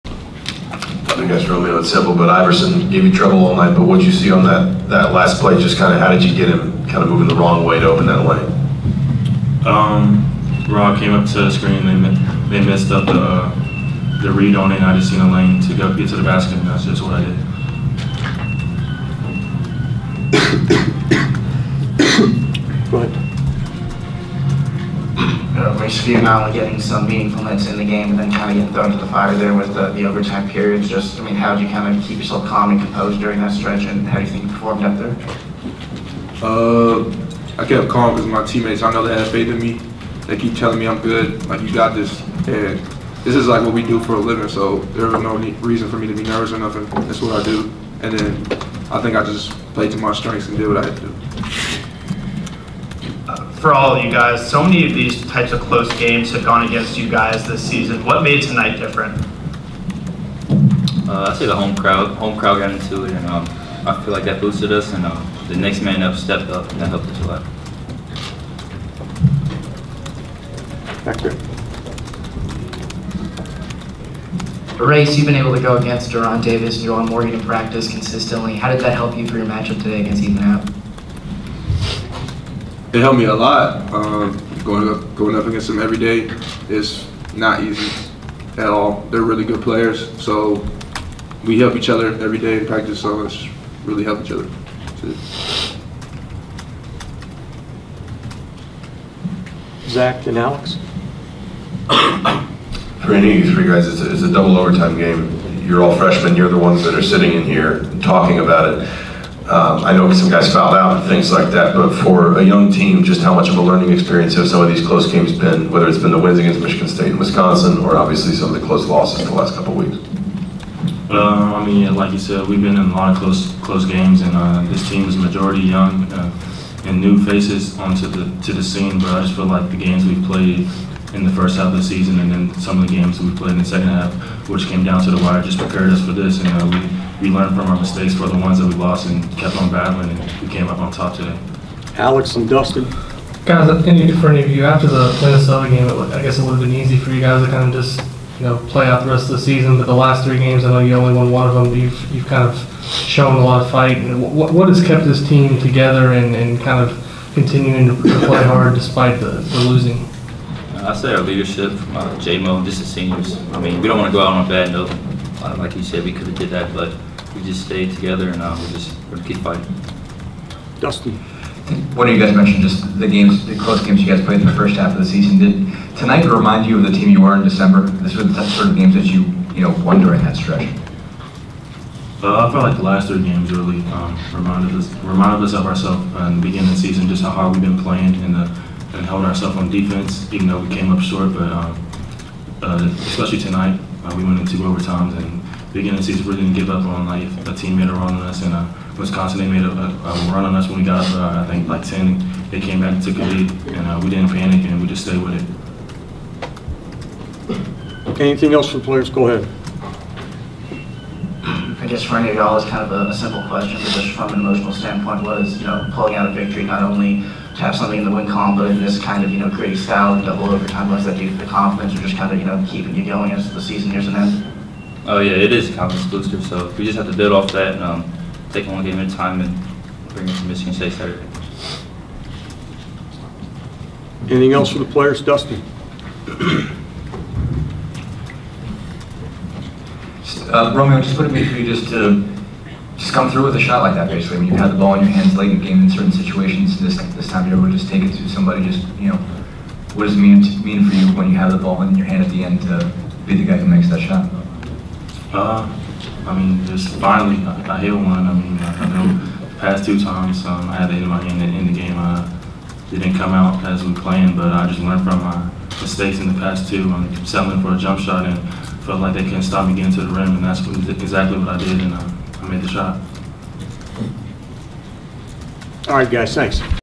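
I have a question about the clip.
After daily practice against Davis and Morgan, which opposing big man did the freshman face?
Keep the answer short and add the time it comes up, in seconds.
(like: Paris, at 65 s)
Ethan Happ, at 80 s.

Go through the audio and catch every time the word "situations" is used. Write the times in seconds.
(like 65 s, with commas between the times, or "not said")
246 s.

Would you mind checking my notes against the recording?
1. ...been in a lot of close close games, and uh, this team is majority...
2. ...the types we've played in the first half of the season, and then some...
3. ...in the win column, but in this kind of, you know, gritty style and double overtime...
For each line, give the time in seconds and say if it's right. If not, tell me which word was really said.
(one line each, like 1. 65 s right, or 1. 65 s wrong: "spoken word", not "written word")
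1. 122 s right
2. 129 s wrong: "games", not "types"
3. 217 s right.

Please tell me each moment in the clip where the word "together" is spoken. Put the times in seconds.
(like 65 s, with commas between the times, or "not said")
155 s, 167 s.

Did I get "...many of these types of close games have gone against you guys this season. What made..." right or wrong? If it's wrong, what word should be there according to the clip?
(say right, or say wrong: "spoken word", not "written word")
right.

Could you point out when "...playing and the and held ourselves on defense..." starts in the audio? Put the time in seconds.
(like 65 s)
187 s.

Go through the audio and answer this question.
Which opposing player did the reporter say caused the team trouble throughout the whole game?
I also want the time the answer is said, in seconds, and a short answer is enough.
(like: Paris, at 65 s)
Iverson, at 2 s.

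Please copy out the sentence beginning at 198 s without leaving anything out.
And uh, Wisconsin, they made a, a, a, run on us when we got up, uh, I think like 10.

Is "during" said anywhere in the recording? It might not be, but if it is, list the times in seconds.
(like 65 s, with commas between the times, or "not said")
33 s, 180 s.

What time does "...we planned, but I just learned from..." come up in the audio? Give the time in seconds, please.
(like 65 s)
263 s.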